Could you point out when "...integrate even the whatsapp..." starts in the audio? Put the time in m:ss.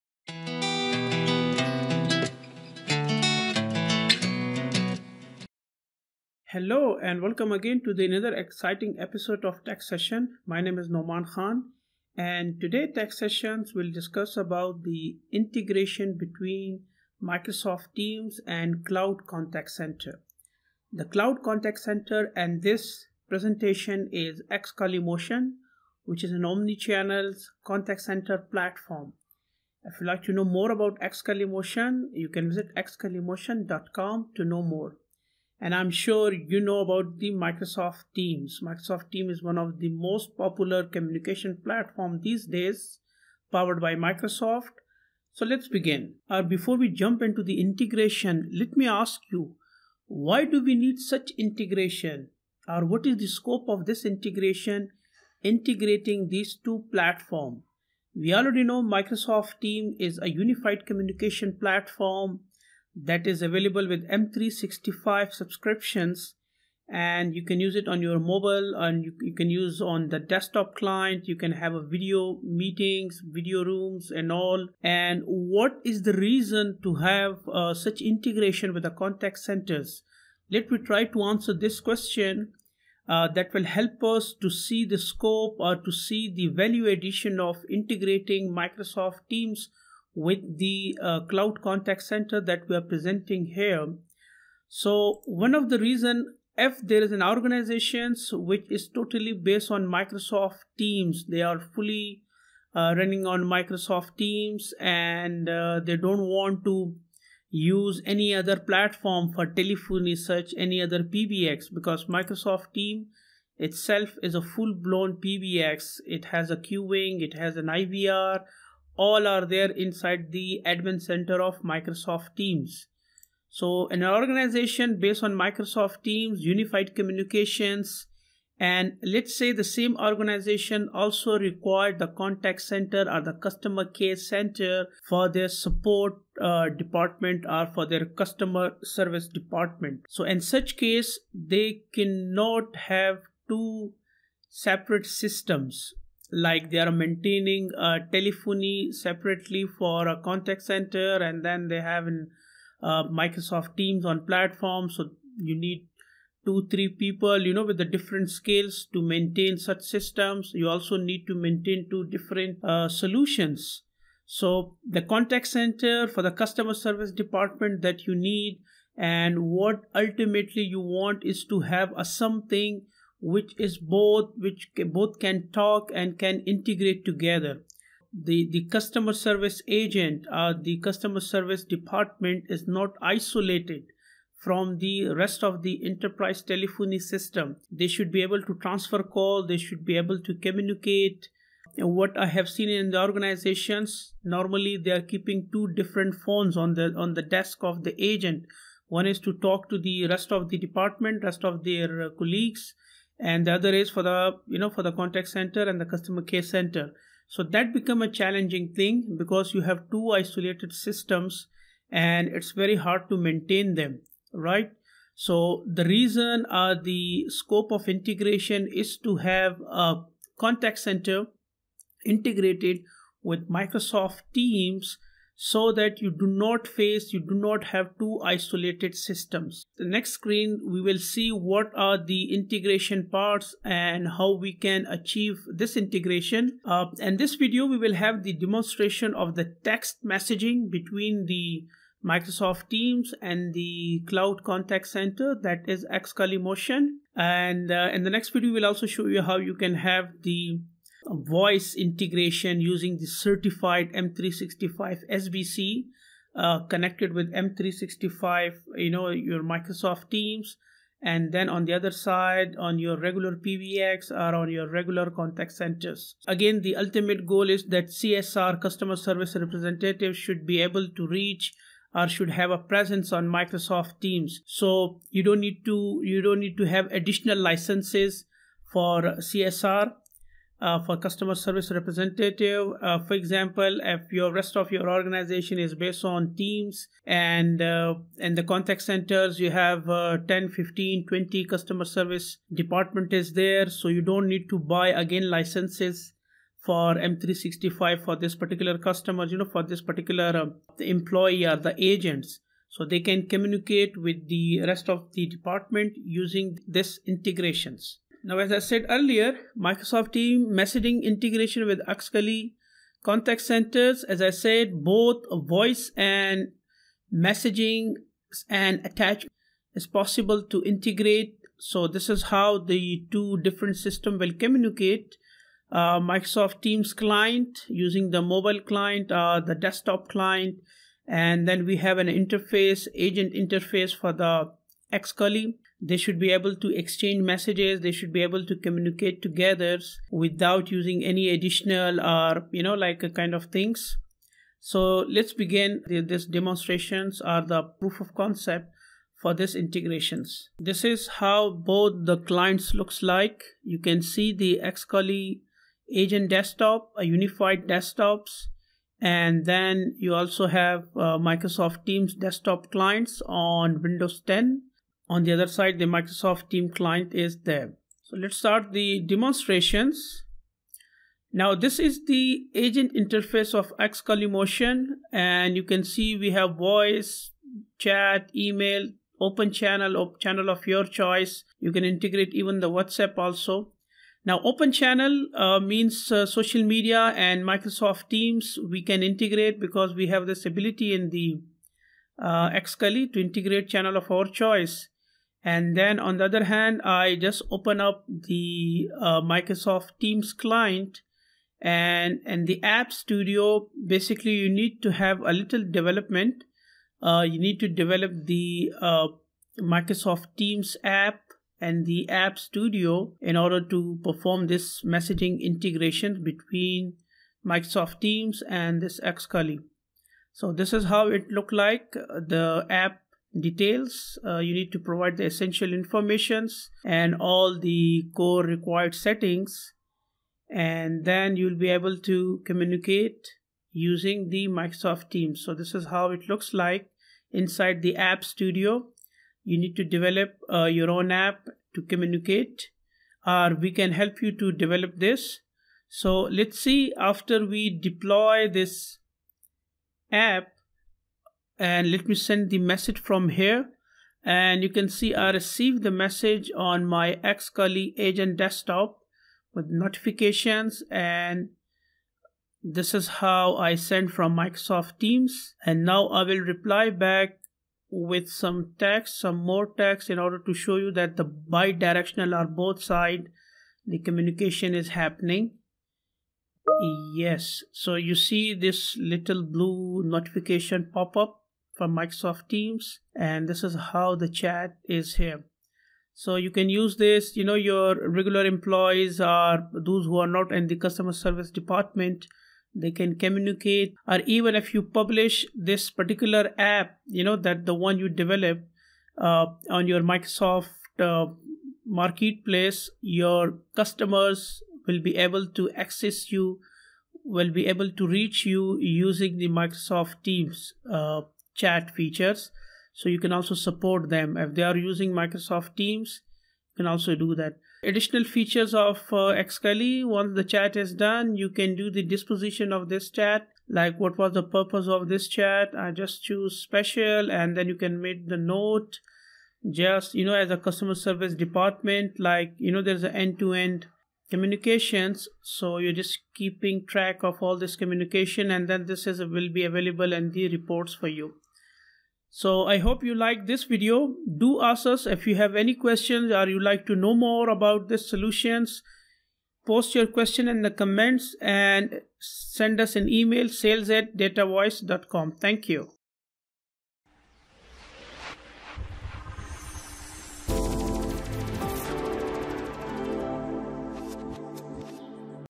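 6:21.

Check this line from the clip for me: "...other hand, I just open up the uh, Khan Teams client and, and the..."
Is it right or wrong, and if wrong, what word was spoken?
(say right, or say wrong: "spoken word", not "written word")
wrong: "Microsoft", not "Khan".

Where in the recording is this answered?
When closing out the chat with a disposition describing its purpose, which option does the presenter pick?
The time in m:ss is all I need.
8:46.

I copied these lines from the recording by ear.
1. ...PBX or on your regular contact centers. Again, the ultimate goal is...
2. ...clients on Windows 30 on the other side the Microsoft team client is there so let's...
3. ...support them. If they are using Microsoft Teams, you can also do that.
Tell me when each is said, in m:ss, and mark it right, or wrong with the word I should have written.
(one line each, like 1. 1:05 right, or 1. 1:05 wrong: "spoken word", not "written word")
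1. 4:23 right
2. 6:02 wrong: "10", not "30"
3. 8:33 right.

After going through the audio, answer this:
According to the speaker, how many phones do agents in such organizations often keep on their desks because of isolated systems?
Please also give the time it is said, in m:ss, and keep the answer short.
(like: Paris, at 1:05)
2, at 3:15.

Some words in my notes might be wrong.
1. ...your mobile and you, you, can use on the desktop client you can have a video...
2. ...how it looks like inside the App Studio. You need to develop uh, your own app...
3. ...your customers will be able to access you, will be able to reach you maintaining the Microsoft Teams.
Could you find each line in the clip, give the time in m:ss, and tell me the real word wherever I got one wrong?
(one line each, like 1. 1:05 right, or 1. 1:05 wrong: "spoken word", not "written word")
1. 1:08 right
2. 7:15 right
3. 8:23 wrong: "using", not "maintaining".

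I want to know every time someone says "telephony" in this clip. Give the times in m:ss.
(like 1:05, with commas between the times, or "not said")
1:49, 2:28, 3:06.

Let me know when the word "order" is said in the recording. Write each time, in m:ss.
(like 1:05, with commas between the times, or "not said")
6:53, 7:50.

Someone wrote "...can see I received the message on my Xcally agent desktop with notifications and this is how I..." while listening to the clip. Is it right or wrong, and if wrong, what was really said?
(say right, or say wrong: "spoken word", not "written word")
right.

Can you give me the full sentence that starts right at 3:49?
The next screen, we will see what are the integration parts and how we can achieve this integration.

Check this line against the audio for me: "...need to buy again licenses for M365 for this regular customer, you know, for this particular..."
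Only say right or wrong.
wrong.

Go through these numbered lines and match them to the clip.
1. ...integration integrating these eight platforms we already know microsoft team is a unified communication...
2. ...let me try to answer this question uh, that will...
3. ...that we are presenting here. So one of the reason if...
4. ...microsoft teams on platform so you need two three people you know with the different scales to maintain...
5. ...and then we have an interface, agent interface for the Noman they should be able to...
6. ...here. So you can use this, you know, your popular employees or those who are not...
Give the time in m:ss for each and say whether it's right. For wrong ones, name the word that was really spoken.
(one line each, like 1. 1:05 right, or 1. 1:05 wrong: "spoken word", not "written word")
1. 0:54 wrong: "two", not "eight"
2. 1:20 right
3. 1:32 right
4. 2:33 right
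5. 5:31 wrong: "Xcally", not "Noman"
6. 8:05 wrong: "regular", not "popular".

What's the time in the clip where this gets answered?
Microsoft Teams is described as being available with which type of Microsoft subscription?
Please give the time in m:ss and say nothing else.
1:04.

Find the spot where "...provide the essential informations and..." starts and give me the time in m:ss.
7:04.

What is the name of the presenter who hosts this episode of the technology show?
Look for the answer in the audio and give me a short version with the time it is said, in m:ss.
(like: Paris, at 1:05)
Noman Khan, at 0:10.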